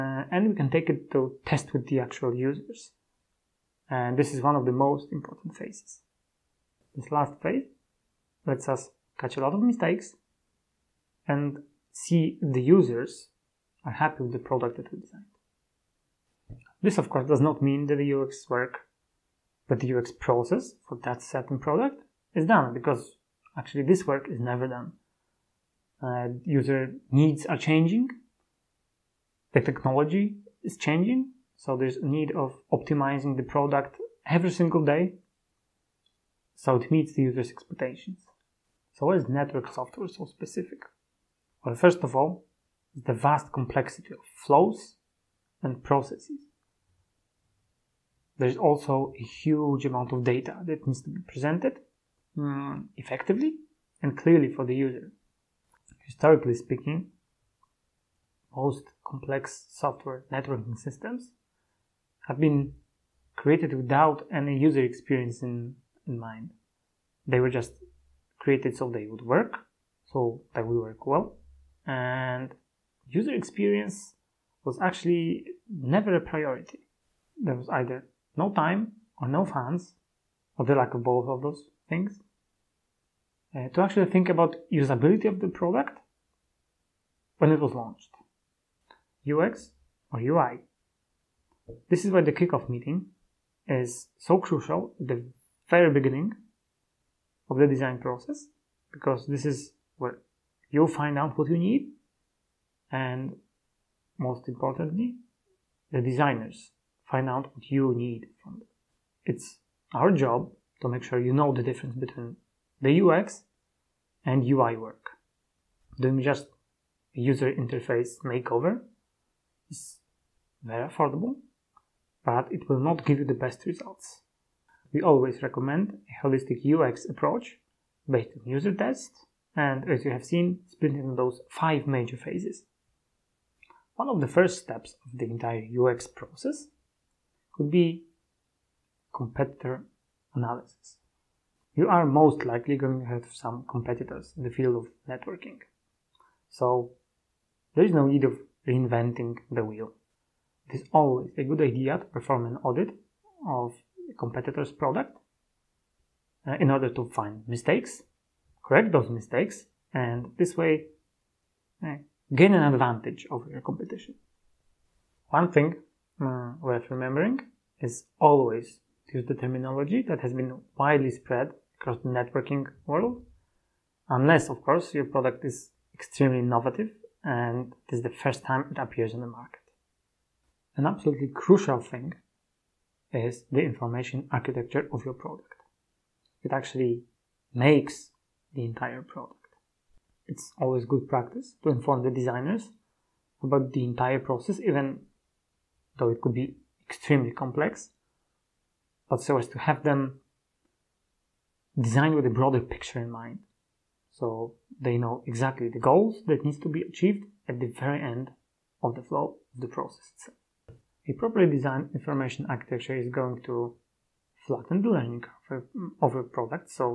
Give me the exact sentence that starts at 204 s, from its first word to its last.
So they know exactly the goals that needs to be achieved at the very end of the flow of the process itself.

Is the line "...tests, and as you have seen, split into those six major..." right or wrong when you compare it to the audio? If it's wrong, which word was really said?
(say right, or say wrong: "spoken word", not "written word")
wrong: "five", not "six".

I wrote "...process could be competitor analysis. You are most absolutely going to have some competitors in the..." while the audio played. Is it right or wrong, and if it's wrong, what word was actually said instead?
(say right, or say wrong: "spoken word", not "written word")
wrong: "likely", not "absolutely".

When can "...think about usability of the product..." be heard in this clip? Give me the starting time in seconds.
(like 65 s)
84 s.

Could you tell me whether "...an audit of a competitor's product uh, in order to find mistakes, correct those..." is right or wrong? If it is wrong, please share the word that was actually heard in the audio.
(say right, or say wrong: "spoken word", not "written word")
right.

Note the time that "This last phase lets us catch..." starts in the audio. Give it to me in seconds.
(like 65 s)
6 s.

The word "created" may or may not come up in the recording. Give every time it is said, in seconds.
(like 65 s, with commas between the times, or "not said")
63 s, 68 s.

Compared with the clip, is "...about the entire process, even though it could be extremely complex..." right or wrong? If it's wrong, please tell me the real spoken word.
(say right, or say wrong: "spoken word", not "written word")
right.